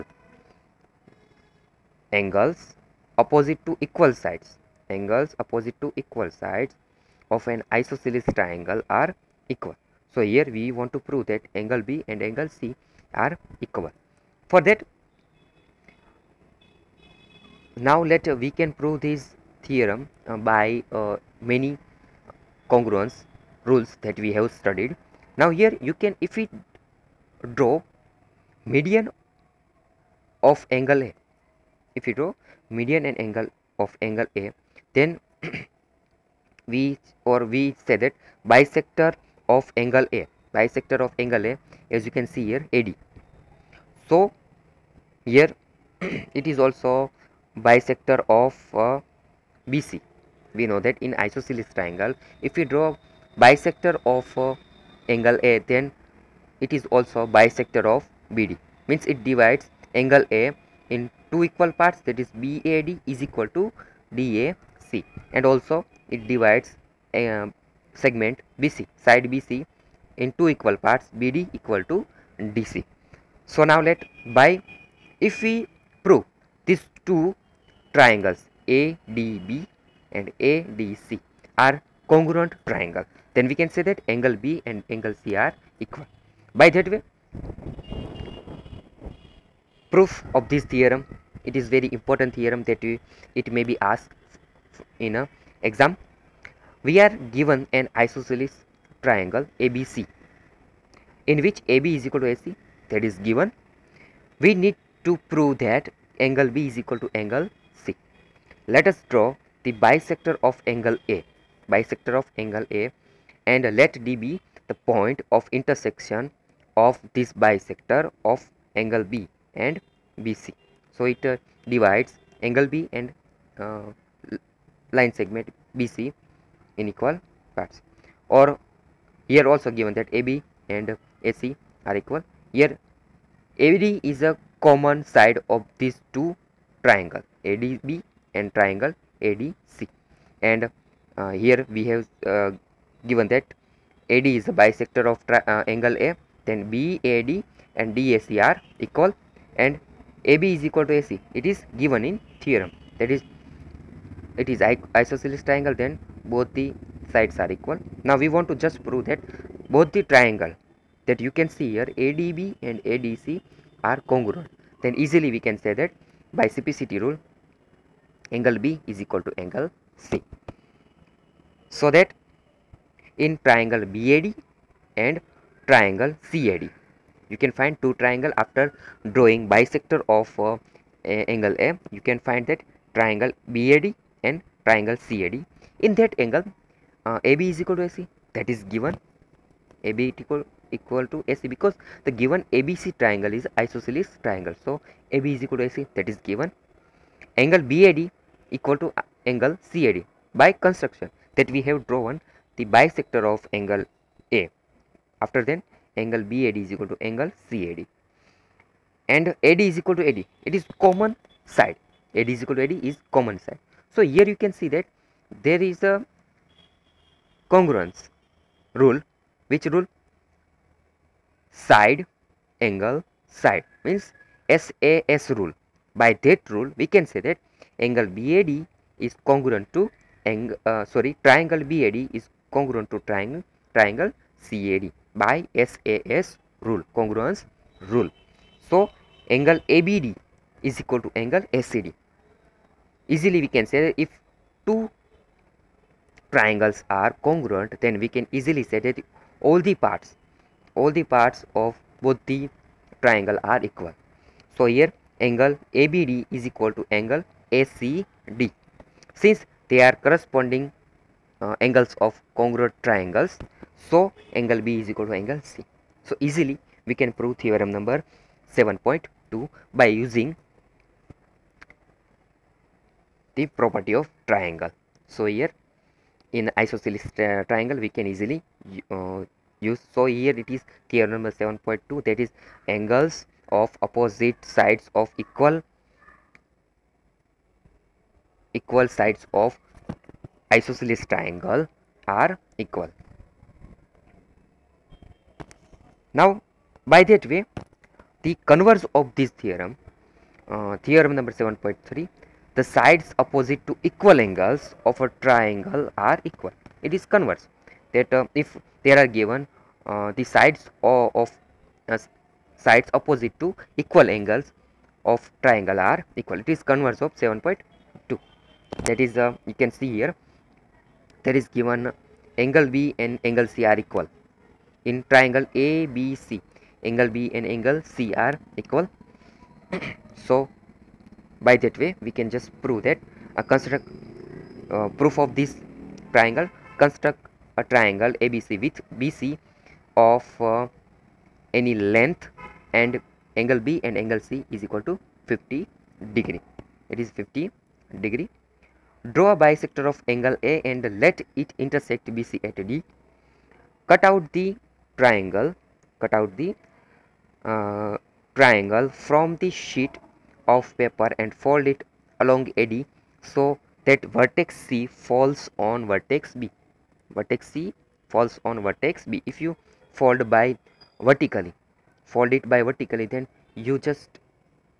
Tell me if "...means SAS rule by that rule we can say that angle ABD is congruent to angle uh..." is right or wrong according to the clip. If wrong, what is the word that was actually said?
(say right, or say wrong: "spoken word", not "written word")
wrong: "BAD", not "ABD".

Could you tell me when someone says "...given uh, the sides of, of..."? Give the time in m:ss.
5:09.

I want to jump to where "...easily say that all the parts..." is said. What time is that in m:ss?
4:08.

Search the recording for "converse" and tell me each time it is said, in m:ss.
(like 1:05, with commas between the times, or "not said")
4:58, 5:07, 5:16.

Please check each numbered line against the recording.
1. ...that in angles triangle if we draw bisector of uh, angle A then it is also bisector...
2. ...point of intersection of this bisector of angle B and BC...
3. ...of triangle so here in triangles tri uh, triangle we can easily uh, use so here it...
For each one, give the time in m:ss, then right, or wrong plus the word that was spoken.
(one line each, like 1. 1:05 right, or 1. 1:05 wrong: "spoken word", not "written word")
1. 0:50 wrong: "isosceles", not "angles"
2. 1:54 right
3. 4:34 wrong: "isosceles", not "triangles".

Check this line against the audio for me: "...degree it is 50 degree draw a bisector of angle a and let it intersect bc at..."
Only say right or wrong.
right.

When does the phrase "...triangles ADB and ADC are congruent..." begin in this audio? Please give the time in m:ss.
1:17.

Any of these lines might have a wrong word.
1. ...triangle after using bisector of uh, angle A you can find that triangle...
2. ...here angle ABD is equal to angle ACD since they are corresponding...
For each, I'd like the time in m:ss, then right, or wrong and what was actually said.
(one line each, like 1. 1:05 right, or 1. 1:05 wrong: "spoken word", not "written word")
1. 2:57 wrong: "drawing", not "using"
2. 4:14 right.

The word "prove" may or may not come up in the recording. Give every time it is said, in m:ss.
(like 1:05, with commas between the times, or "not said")
0:11, 0:18, 1:16, 1:45, 2:38, 4:27, 5:32.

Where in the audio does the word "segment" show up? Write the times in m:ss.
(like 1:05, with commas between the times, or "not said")
1:08, 2:05.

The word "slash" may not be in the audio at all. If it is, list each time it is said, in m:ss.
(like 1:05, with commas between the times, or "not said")
not said.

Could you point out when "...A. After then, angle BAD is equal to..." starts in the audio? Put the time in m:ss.
3:24.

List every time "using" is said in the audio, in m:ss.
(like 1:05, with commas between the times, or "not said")
4:30.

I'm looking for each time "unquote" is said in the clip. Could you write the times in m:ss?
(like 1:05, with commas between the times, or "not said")
not said.